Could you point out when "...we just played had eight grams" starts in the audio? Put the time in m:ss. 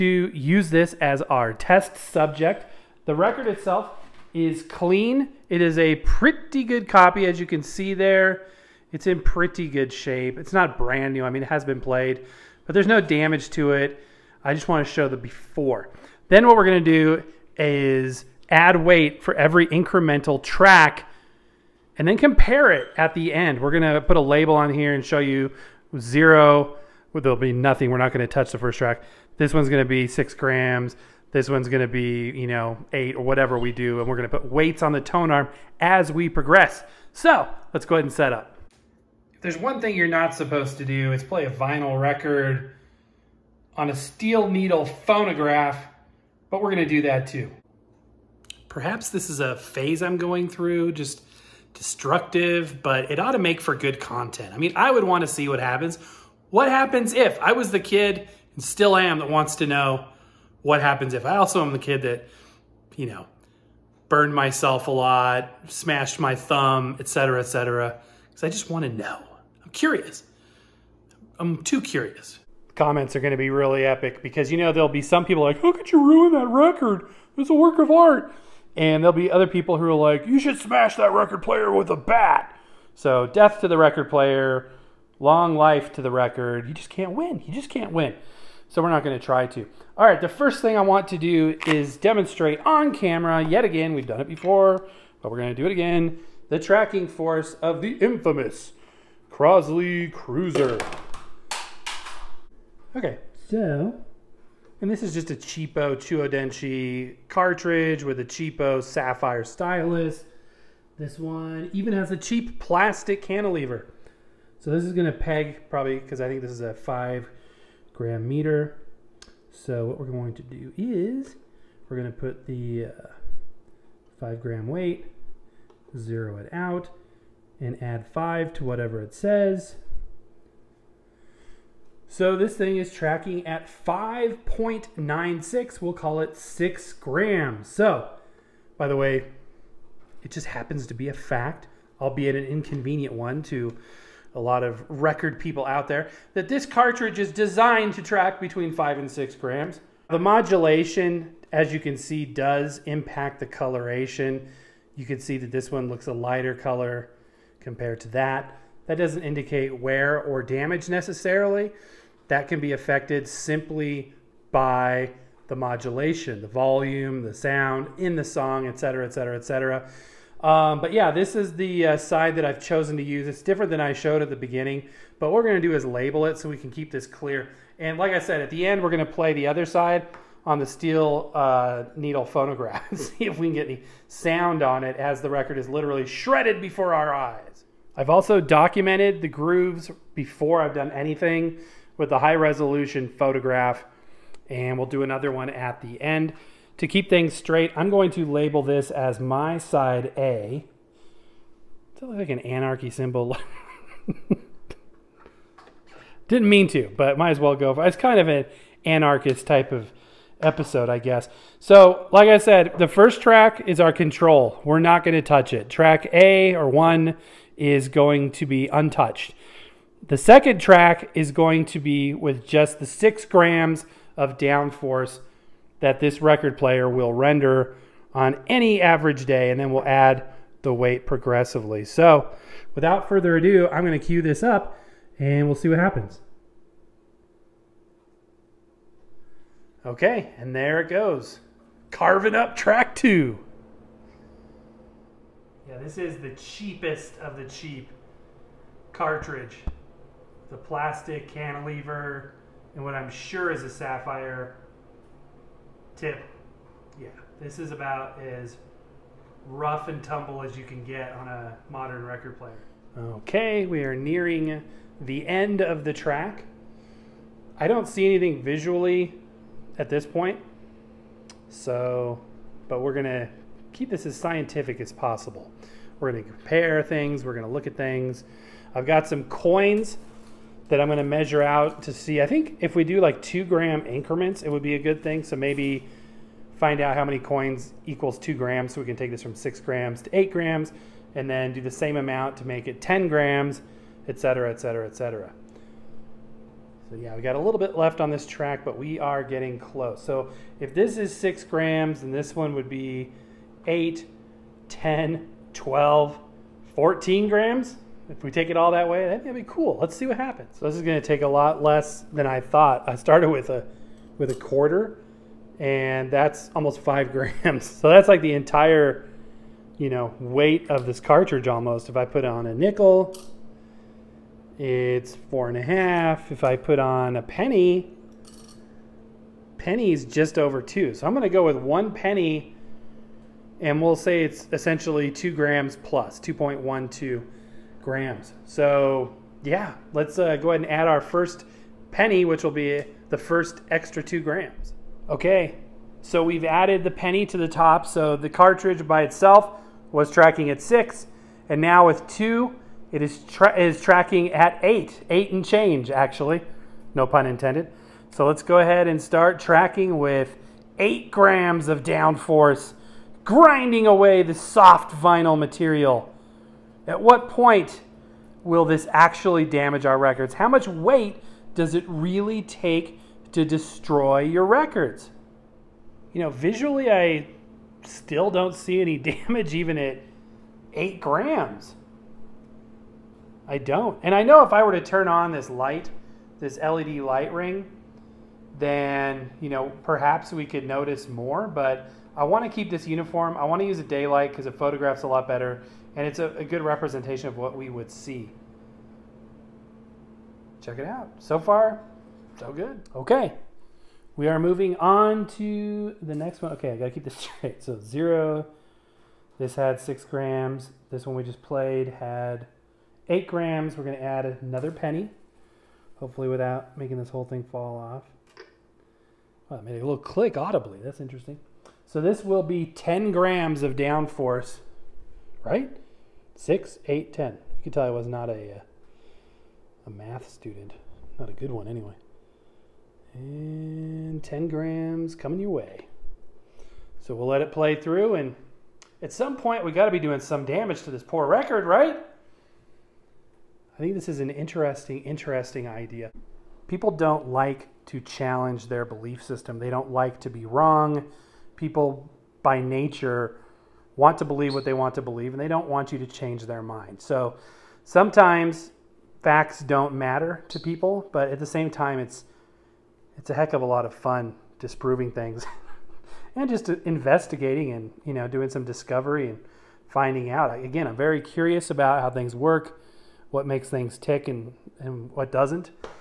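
6:51.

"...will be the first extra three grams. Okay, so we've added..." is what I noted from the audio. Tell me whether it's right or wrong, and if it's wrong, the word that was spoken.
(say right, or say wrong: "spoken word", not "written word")
wrong: "two", not "three".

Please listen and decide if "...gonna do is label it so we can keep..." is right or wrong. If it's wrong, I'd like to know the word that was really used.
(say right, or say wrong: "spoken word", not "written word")
right.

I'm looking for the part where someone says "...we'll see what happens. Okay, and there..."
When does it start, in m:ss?
3:55.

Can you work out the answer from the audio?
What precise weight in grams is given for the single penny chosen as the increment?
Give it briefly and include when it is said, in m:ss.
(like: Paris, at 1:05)
2.12, at 5:36.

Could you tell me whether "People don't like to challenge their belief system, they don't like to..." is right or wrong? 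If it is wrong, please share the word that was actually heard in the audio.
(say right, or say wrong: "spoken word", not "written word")
right.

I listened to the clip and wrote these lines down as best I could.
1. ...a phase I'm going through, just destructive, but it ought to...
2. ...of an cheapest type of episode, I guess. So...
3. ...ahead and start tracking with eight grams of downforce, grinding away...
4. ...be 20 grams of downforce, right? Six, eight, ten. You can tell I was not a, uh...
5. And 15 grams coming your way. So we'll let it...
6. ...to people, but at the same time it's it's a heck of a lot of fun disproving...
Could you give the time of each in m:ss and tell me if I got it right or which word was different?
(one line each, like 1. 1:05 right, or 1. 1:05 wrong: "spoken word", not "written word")
1. 0:49 right
2. 3:28 wrong: "anarchist", not "cheapest"
3. 5:58 right
4. 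7:02 wrong: "10", not "20"
5. 7:13 wrong: "10", not "15"
6. 7:40 right.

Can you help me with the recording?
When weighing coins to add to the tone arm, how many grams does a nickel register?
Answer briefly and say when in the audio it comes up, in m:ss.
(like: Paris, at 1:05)
4.5, at 5:25.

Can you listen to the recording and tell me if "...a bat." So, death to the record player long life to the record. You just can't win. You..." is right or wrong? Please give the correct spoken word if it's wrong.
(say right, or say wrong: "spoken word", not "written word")
right.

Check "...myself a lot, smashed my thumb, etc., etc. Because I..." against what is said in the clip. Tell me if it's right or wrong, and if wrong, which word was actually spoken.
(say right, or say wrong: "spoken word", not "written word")
right.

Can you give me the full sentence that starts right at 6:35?
And it's a, a good representation of what we would see.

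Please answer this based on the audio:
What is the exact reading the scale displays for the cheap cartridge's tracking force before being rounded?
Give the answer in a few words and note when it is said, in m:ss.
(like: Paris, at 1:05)
5.96, at 2:13.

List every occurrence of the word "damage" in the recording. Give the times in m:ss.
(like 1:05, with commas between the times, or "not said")
0:13, 2:40, 6:09, 6:18, 7:20.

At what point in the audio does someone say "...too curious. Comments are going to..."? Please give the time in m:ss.
1:11.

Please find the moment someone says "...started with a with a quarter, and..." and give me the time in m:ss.
5:12.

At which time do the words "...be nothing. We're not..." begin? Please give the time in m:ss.
0:27.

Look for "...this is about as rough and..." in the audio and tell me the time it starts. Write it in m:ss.
4:17.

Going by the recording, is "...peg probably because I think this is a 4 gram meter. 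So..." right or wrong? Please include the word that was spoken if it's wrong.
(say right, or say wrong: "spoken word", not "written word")
wrong: "5", not "4".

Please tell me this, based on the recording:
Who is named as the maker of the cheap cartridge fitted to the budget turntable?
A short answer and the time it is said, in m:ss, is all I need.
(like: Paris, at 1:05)
Chuo Denshi, at 1:45.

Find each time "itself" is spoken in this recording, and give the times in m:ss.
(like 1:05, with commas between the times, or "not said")
0:03, 5:49.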